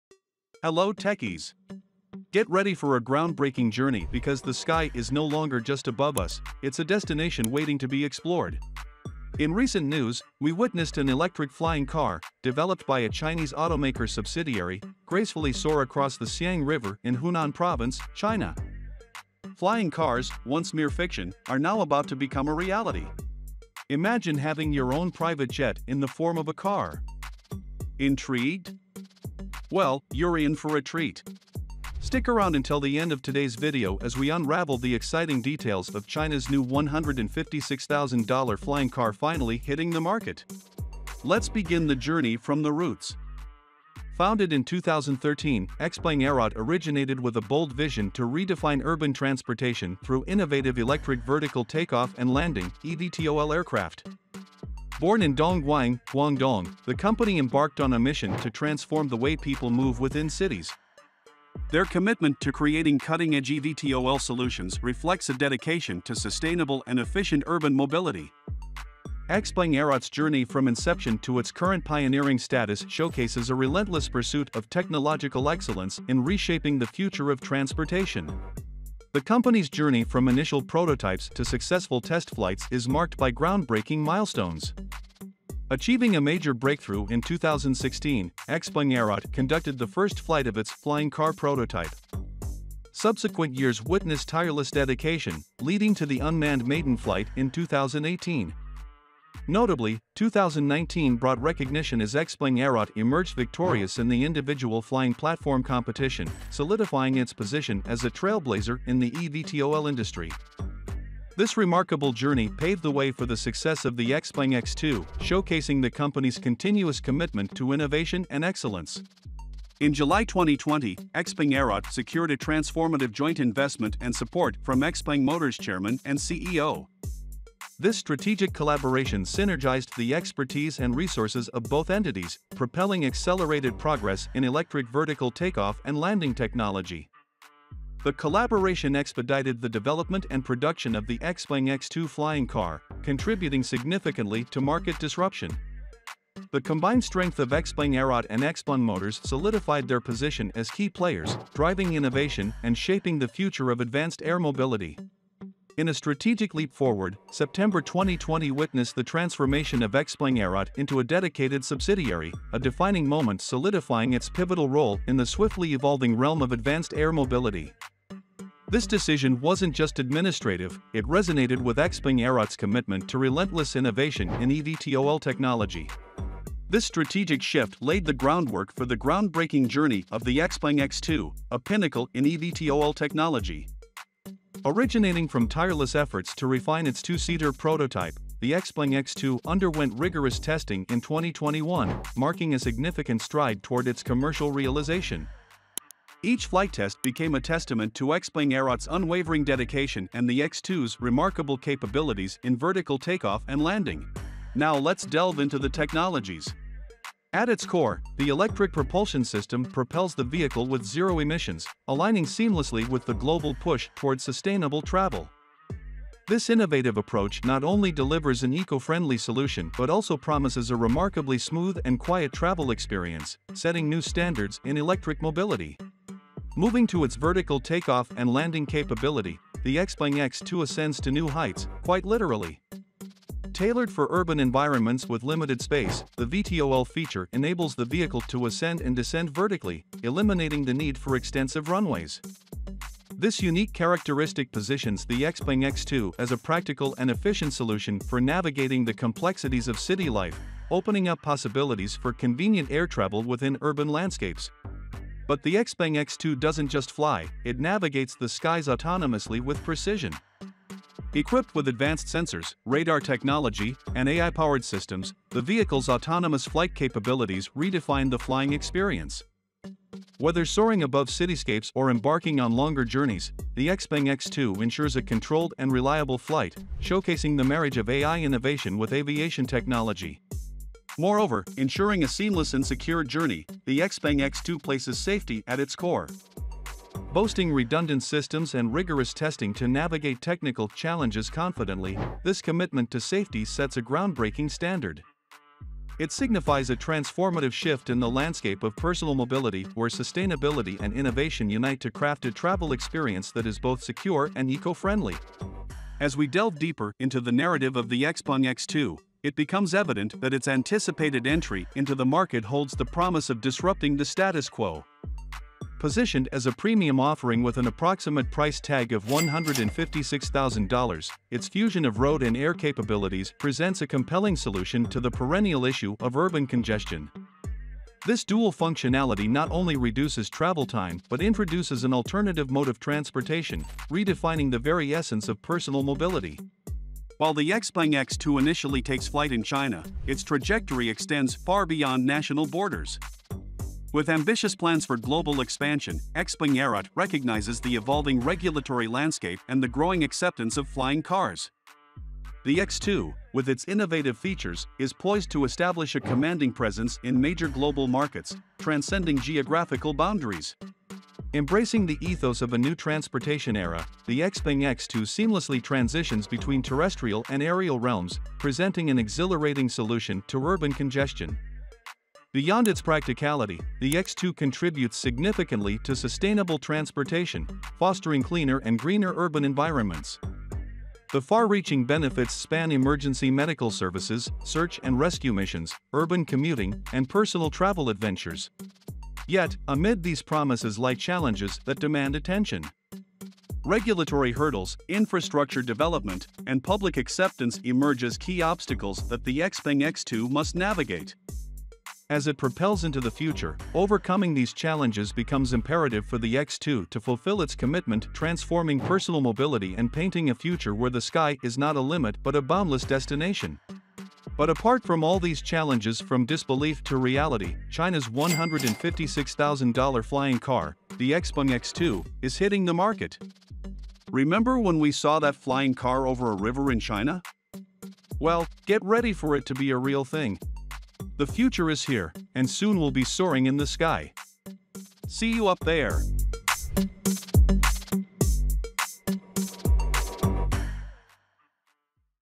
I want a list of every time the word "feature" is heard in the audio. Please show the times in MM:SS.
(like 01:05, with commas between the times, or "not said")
03:56, 05:54.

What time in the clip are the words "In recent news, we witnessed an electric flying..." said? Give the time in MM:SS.
00:09.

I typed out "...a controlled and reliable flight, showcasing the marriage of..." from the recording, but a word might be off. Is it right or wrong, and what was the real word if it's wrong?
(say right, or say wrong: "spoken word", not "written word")
right.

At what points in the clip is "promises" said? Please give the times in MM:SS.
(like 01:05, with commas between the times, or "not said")
03:40, 05:12, 06:30.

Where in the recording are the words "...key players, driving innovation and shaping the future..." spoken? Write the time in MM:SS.
02:30.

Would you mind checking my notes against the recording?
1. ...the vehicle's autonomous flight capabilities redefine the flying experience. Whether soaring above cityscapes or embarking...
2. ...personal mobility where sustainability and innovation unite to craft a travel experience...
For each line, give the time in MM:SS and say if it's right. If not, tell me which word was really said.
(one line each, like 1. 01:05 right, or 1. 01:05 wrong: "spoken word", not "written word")
1. 04:25 right
2. 04:58 right.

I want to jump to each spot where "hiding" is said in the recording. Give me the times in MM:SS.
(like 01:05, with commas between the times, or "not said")
not said.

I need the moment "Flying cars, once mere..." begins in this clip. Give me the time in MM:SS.
00:19.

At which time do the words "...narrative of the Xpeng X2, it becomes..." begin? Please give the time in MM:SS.
05:07.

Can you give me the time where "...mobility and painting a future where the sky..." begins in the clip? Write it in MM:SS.
06:49.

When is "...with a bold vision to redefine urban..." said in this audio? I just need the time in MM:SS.
00:47.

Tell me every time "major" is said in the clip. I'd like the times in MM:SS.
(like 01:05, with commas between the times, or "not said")
01:26, 05:57.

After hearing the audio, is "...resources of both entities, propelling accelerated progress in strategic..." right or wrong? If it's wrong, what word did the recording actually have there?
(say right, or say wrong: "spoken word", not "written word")
wrong: "electric", not "strategic".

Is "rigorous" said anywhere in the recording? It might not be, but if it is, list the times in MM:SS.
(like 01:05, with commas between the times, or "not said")
03:09, 04:48.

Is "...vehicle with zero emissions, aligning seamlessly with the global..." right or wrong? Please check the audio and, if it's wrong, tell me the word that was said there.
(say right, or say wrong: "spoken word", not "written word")
right.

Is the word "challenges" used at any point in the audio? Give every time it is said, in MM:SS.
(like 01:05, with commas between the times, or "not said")
04:50, 06:30, 06:44, 06:55.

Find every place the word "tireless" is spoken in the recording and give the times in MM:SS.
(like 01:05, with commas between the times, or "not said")
01:34, 03:05.